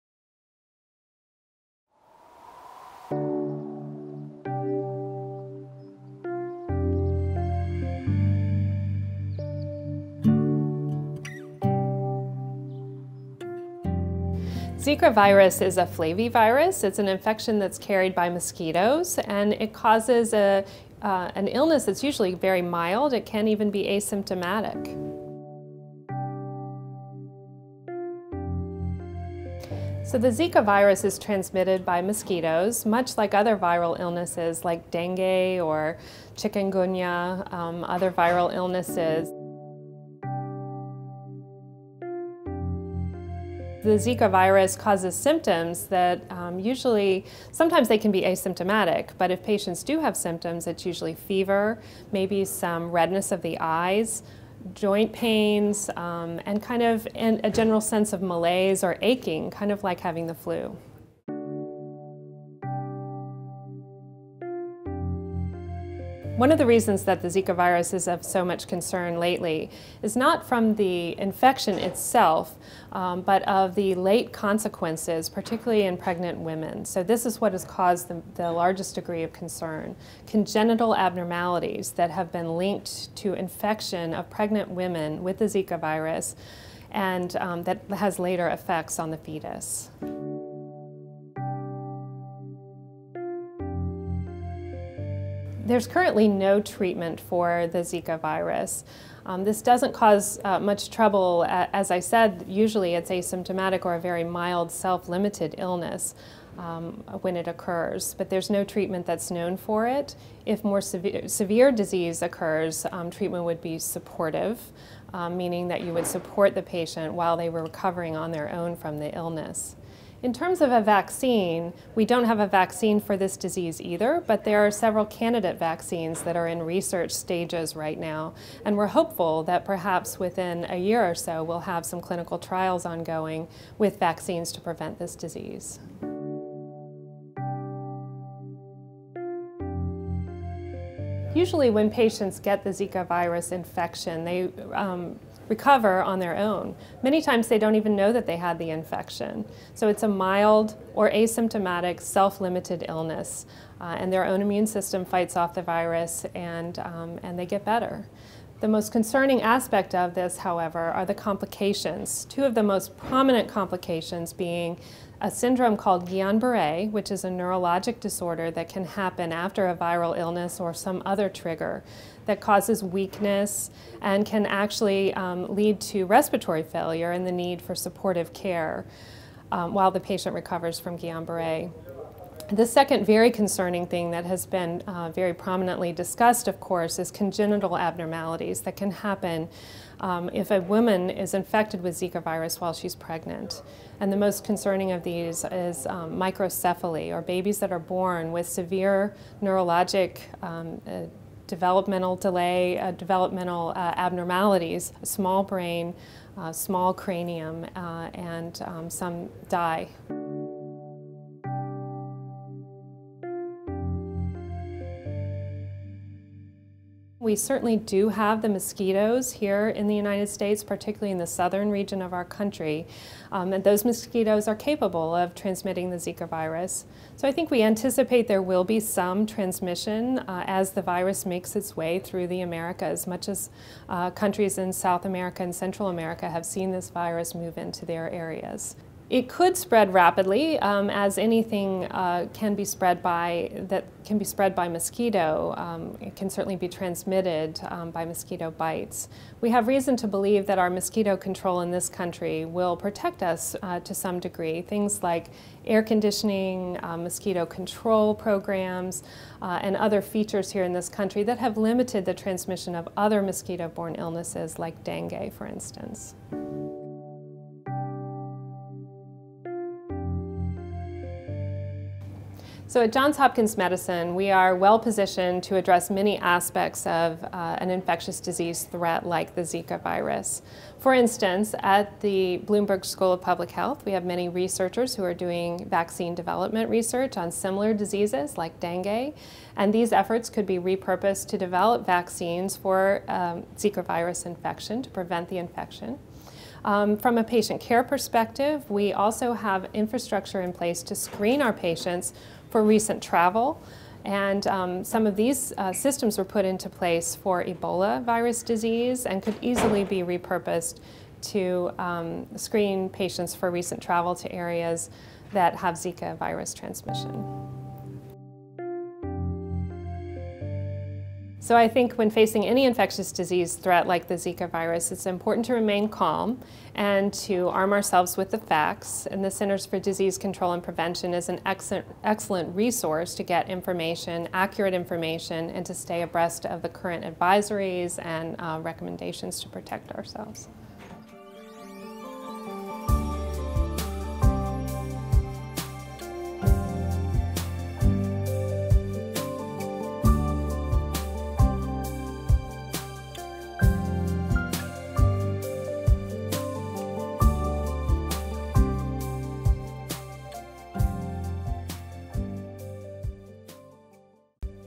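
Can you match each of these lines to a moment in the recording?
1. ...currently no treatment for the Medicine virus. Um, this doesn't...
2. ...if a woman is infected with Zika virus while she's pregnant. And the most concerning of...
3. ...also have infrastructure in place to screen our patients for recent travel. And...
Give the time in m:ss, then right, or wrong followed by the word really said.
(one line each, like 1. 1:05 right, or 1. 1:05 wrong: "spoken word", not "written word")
1. 1:35 wrong: "Zika", not "Medicine"
2. 3:10 right
3. 4:58 right.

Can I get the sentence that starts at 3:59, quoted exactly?
It could spread rapidly, um, as anything uh, can be spread by that can be spread by mosquito.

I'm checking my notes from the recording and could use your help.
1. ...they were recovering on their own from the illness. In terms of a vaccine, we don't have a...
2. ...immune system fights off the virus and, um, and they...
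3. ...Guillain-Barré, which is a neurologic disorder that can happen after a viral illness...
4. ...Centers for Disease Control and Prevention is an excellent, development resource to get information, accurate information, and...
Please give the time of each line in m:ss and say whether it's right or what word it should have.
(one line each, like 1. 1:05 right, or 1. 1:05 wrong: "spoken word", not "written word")
1. 1:57 right
2. 2:34 right
3. 2:46 right
4. 5:29 wrong: "excellent", not "development".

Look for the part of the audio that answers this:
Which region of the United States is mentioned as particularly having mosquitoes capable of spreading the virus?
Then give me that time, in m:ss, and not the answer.
3:41.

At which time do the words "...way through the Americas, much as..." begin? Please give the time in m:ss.
3:51.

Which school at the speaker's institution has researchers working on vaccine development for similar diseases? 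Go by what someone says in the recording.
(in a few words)
Bloomberg School of Public Health.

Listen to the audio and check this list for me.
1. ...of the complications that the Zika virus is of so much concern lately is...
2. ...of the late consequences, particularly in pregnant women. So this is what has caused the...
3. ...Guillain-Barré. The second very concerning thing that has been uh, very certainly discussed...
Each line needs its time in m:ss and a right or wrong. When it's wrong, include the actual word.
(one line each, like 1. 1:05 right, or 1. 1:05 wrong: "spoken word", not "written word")
1. 1:06 wrong: "reasons", not "complications"
2. 1:13 right
3. 3:00 wrong: "prominently", not "certainly".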